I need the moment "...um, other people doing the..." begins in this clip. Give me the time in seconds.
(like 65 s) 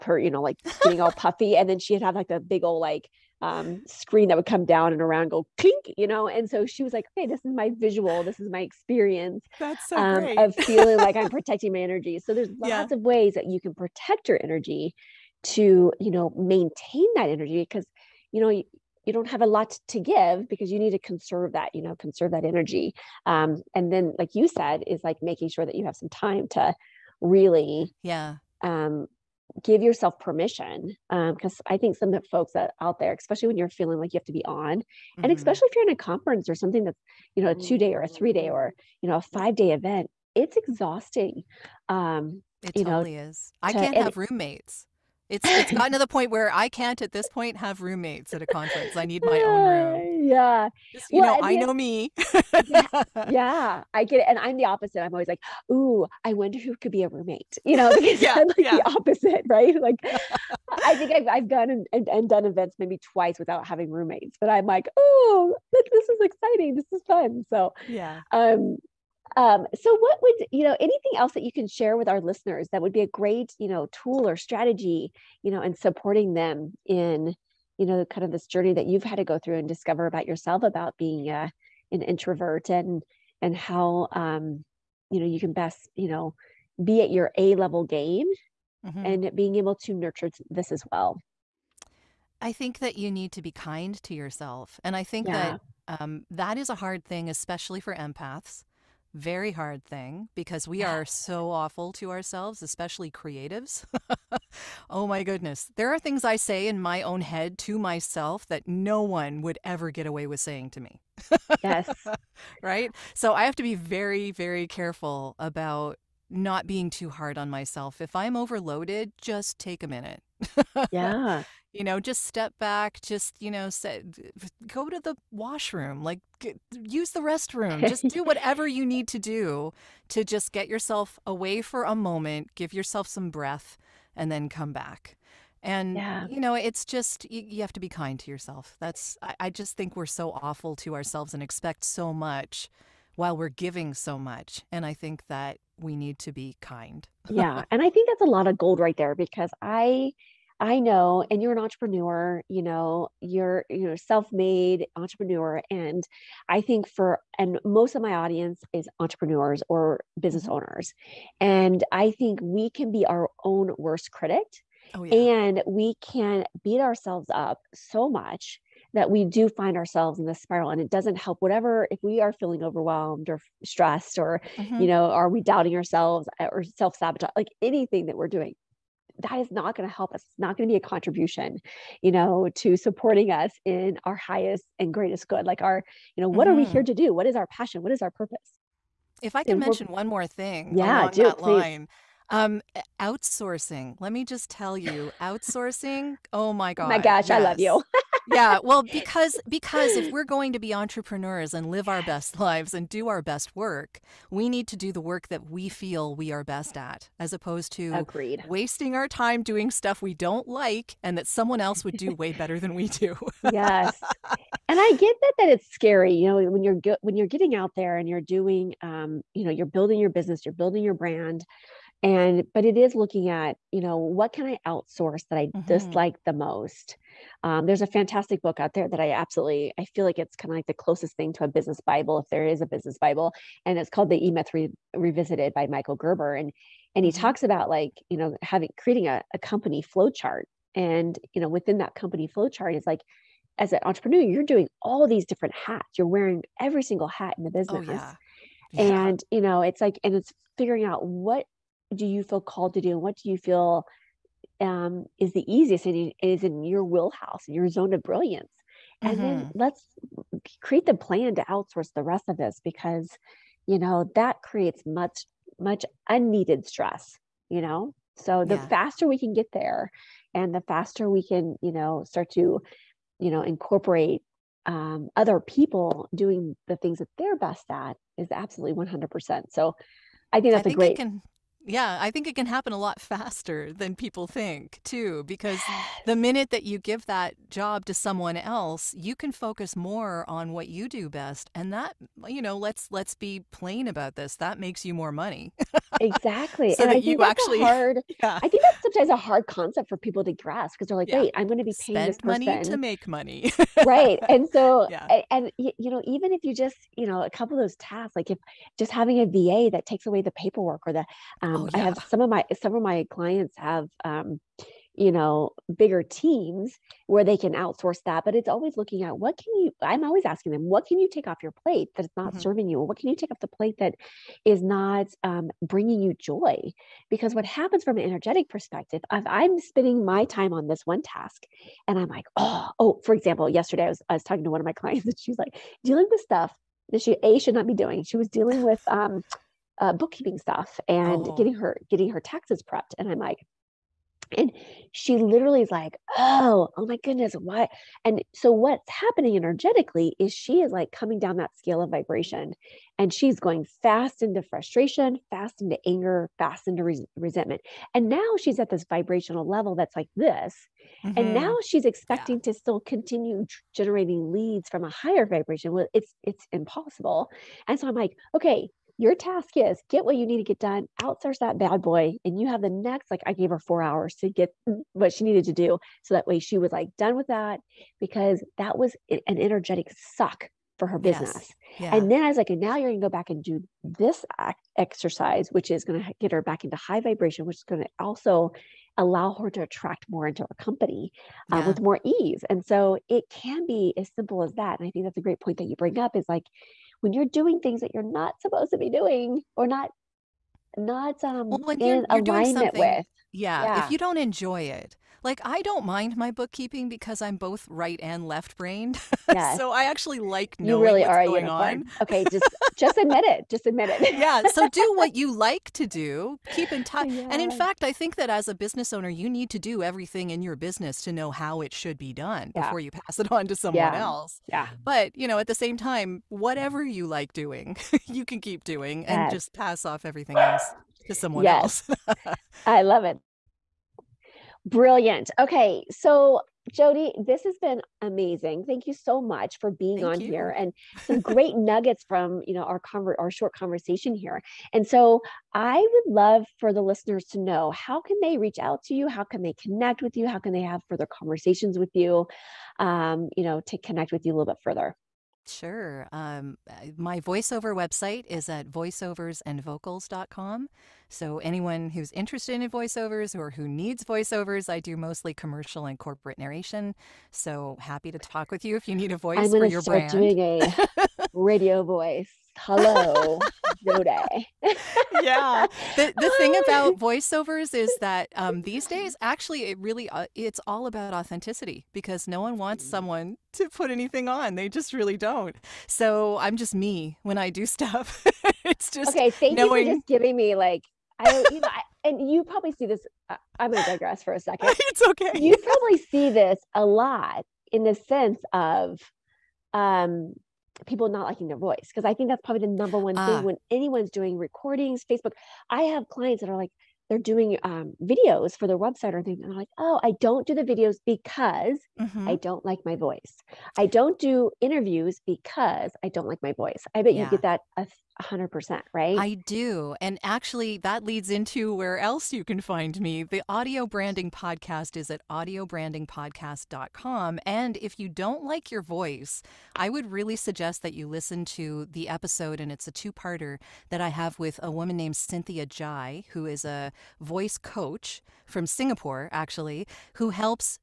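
274 s.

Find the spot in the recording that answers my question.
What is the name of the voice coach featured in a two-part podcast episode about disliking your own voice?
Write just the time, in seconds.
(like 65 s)
535 s.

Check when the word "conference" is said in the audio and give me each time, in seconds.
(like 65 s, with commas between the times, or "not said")
35 s, 48 s.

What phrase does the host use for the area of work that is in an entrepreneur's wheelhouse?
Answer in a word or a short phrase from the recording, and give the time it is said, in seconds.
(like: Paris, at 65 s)
zone of brilliance, at 257 s.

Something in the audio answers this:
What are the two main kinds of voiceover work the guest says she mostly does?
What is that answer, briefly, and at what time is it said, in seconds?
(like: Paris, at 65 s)
commercial and corporate narration, at 465 s.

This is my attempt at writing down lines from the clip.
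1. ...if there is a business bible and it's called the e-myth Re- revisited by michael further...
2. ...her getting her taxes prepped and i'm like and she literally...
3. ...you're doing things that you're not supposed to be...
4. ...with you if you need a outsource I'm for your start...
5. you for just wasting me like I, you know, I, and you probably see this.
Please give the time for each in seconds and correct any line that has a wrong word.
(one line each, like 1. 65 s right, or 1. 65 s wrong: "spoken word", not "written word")
1. 232 s wrong: "gerber", not "further"
2. 341 s right
3. 397 s right
4. 468 s wrong: "voice", not "outsource"
5. 489 s wrong: "giving", not "wasting".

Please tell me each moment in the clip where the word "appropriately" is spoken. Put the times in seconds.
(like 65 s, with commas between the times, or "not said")
not said.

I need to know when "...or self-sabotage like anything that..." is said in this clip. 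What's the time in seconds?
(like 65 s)
176 s.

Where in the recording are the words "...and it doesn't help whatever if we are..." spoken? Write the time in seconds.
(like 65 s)
170 s.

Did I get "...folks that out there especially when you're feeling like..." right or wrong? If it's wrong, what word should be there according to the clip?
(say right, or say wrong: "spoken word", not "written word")
right.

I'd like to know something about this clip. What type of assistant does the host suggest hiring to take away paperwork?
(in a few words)
VA.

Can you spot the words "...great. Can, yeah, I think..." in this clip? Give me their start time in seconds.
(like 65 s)
280 s.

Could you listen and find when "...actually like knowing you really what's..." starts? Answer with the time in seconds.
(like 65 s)
409 s.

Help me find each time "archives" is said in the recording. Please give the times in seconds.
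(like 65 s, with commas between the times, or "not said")
not said.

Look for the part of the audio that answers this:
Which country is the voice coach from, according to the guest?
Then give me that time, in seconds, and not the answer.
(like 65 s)
538 s.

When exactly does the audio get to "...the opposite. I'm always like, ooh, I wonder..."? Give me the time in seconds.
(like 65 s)
54 s.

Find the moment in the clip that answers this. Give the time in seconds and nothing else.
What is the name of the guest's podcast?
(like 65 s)
523 s.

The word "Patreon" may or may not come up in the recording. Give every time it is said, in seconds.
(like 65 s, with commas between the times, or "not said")
not said.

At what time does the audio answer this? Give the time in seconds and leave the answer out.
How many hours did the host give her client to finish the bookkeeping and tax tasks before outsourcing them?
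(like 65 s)
373 s.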